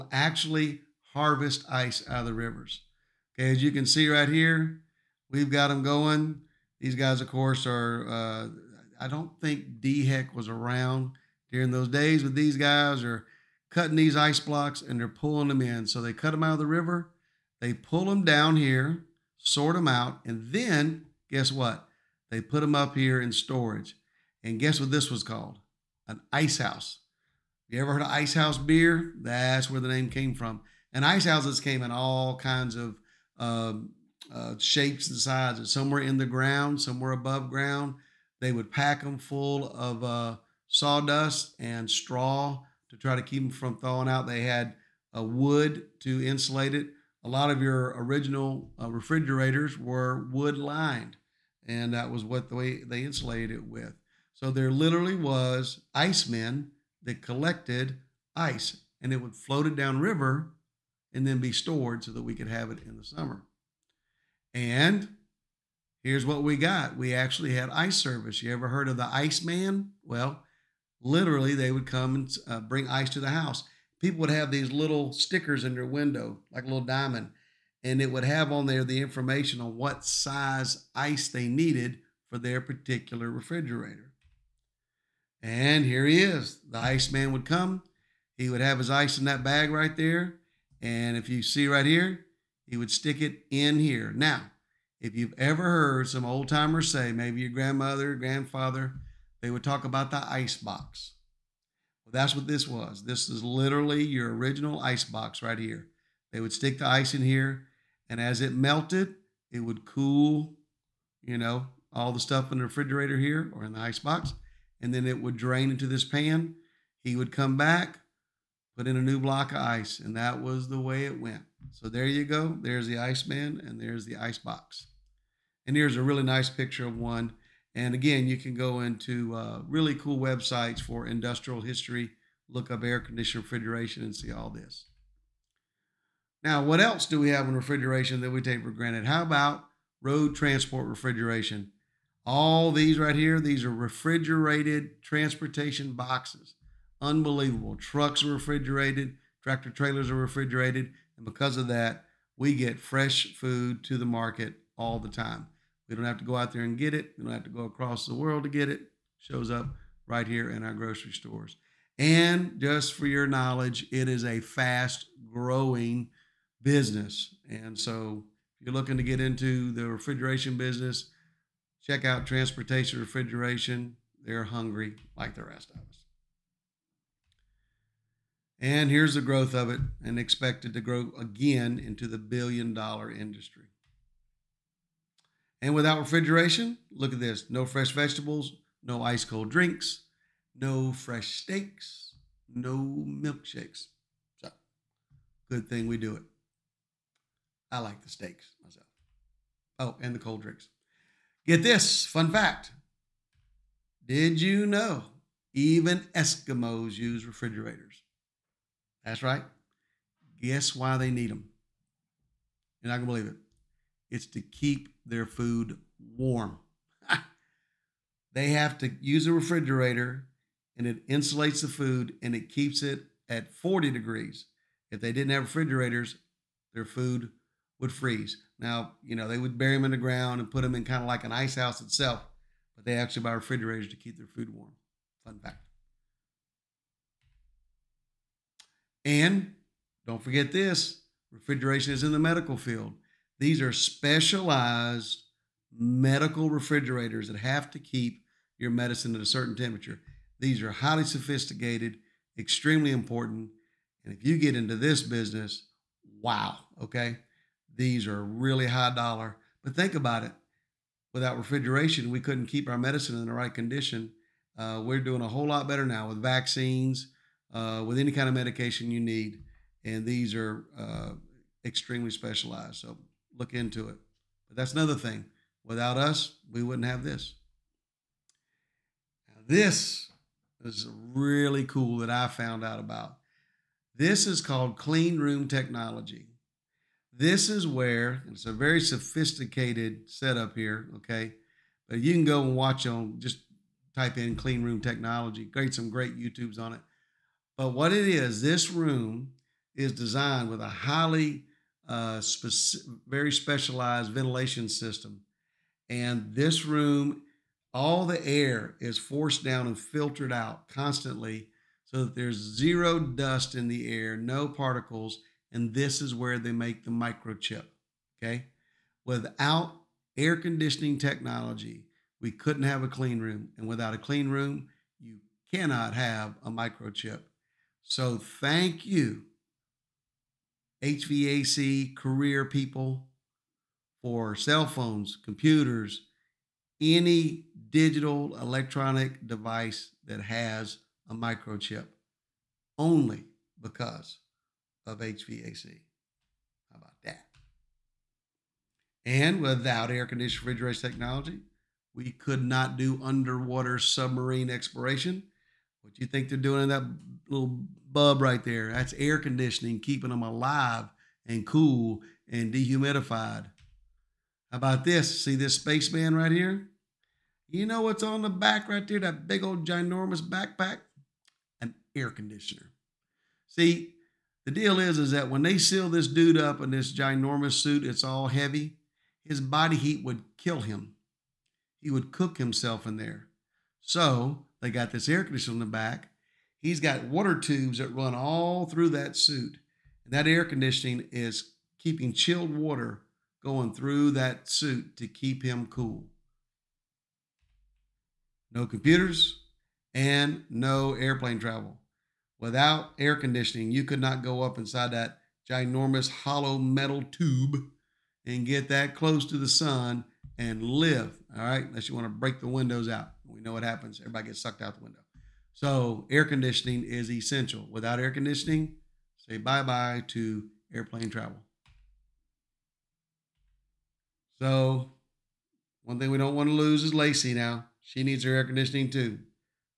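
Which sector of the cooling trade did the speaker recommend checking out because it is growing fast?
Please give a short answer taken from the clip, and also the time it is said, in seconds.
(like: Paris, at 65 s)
Transportation Refrigeration, at 172 s.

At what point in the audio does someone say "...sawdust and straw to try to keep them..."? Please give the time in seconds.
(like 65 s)
40 s.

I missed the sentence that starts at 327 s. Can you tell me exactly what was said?
So thank you HVAC career people, for cell phones, computers, any digital electronic device that has a microchip only because of HVAC.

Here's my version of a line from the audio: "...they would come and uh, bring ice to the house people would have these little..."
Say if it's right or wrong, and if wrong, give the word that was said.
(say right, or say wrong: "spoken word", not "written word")
right.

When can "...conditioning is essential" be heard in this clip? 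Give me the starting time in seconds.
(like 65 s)
416 s.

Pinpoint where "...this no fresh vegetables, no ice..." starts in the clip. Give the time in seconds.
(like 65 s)
187 s.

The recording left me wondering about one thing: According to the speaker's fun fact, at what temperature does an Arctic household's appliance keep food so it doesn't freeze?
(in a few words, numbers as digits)
40 degrees.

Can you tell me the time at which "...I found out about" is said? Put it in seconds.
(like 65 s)
282 s.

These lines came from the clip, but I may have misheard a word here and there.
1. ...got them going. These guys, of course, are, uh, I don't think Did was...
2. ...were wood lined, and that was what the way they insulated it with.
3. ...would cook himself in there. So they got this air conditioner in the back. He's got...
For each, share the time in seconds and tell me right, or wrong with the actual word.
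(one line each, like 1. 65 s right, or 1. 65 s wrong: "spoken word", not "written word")
1. 5 s wrong: "DHEC", not "Did"
2. 49 s right
3. 381 s right.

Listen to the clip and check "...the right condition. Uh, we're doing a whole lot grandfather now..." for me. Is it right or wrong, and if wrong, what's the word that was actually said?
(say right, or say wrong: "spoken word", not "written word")
wrong: "better", not "grandfather".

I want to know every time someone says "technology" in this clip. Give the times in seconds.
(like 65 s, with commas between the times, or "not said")
285 s, 294 s, 320 s, 350 s.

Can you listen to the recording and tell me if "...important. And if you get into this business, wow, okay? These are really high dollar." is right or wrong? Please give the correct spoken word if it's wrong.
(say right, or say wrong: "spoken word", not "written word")
right.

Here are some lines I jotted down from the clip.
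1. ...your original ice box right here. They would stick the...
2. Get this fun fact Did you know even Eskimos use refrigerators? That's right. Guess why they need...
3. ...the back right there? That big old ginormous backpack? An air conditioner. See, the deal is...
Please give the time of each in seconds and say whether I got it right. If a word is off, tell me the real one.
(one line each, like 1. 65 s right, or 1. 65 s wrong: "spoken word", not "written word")
1. 104 s right
2. 201 s right
3. 368 s right.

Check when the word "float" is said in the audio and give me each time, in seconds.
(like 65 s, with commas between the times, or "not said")
59 s.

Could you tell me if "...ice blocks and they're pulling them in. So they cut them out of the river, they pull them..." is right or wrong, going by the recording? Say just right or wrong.
right.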